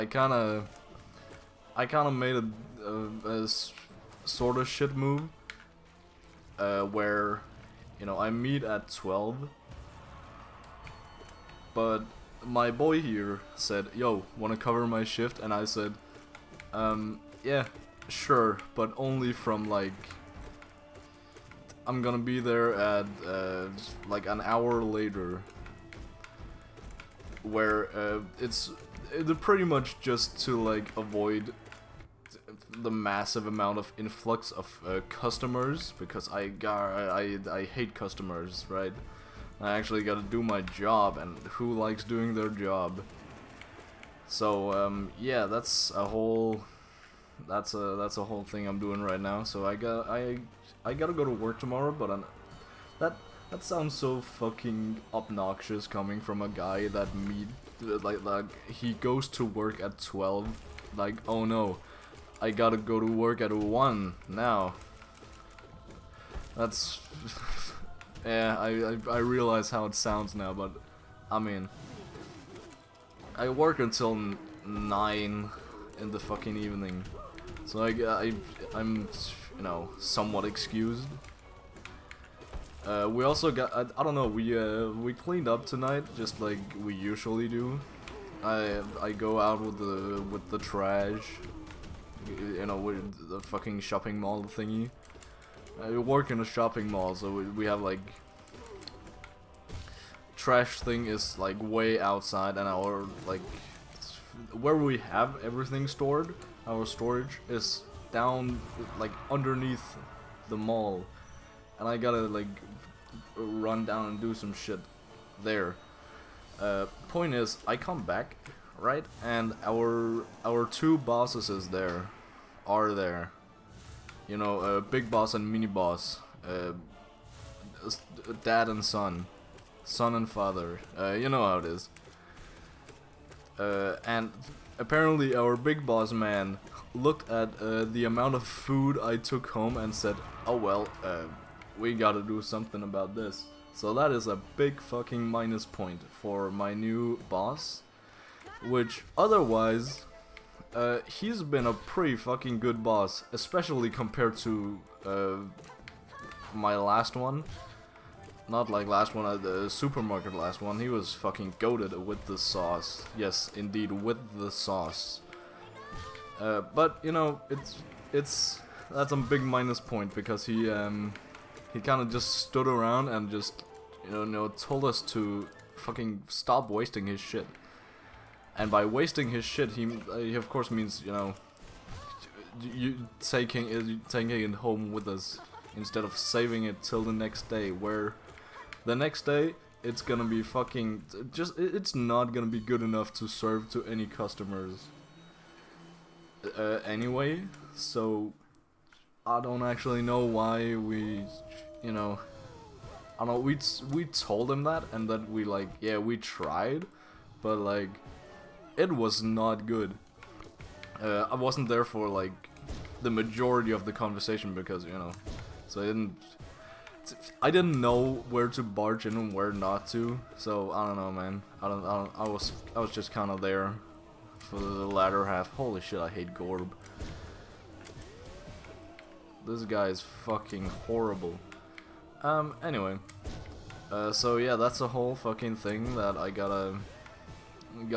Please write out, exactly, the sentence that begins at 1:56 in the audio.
Uh, point is, I come back, right?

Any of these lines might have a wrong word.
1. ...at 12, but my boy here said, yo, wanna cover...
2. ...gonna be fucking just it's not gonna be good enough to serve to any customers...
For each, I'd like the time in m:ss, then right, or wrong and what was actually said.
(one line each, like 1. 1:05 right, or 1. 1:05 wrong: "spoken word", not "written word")
1. 0:08 right
2. 3:10 right.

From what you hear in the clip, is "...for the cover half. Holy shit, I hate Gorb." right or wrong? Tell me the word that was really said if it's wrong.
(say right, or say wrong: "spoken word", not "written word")
wrong: "latter", not "cover".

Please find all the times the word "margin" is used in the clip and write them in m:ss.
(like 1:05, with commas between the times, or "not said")
not said.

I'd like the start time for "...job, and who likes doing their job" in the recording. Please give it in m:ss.
0:40.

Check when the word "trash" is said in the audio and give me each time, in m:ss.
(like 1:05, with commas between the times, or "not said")
1:30, 1:40.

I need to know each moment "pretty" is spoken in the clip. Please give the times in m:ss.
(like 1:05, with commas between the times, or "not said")
0:29, 2:31.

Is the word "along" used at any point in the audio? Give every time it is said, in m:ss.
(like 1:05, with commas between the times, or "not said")
not said.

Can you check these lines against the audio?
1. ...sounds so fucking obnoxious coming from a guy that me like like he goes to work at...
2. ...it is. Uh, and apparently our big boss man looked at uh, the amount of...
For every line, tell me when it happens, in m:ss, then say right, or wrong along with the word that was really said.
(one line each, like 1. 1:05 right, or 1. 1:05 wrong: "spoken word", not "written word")
1. 0:53 right
2. 2:11 right.